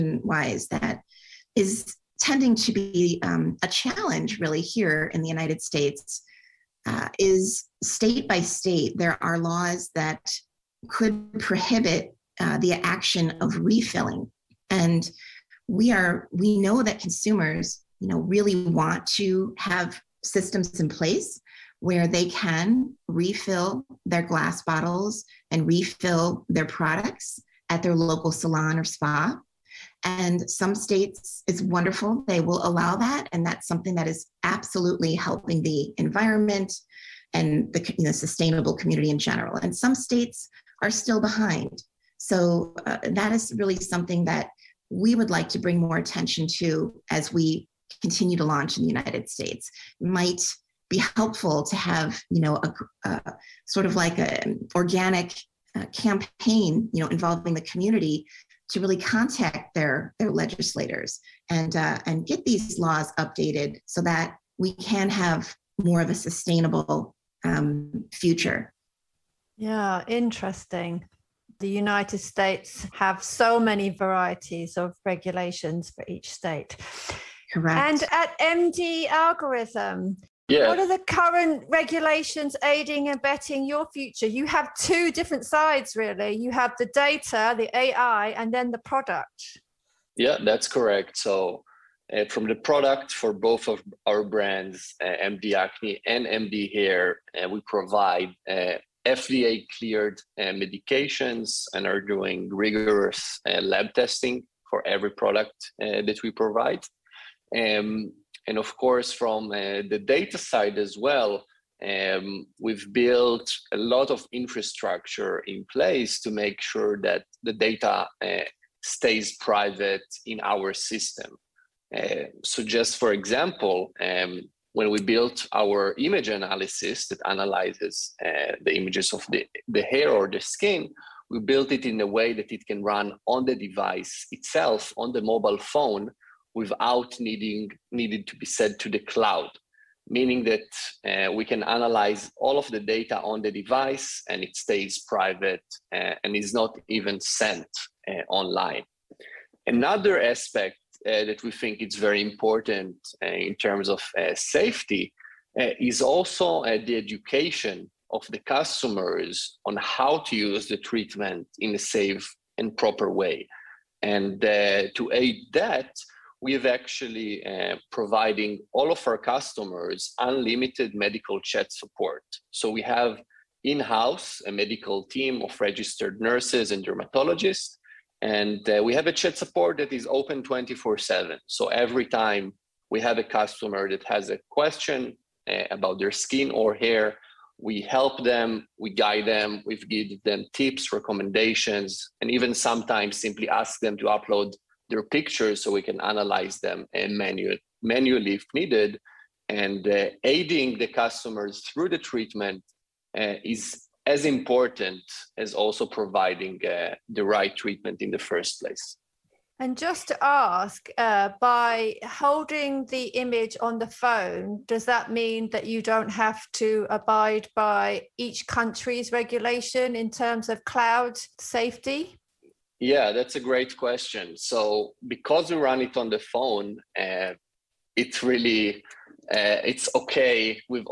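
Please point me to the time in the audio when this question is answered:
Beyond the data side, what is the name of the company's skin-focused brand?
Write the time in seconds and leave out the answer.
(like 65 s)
95 s.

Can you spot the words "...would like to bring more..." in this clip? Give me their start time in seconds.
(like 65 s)
45 s.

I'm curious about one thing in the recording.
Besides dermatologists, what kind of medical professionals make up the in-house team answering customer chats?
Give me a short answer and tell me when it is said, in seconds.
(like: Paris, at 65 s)
Registered nurses, at 175 s.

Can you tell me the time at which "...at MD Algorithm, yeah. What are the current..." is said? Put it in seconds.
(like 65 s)
78 s.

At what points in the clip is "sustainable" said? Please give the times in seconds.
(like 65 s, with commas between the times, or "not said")
38 s, 66 s.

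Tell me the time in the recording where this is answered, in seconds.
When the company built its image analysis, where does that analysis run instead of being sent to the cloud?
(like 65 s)
134 s.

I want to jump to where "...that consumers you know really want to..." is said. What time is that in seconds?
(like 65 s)
16 s.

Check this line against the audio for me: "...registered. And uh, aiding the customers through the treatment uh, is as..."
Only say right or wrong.
wrong.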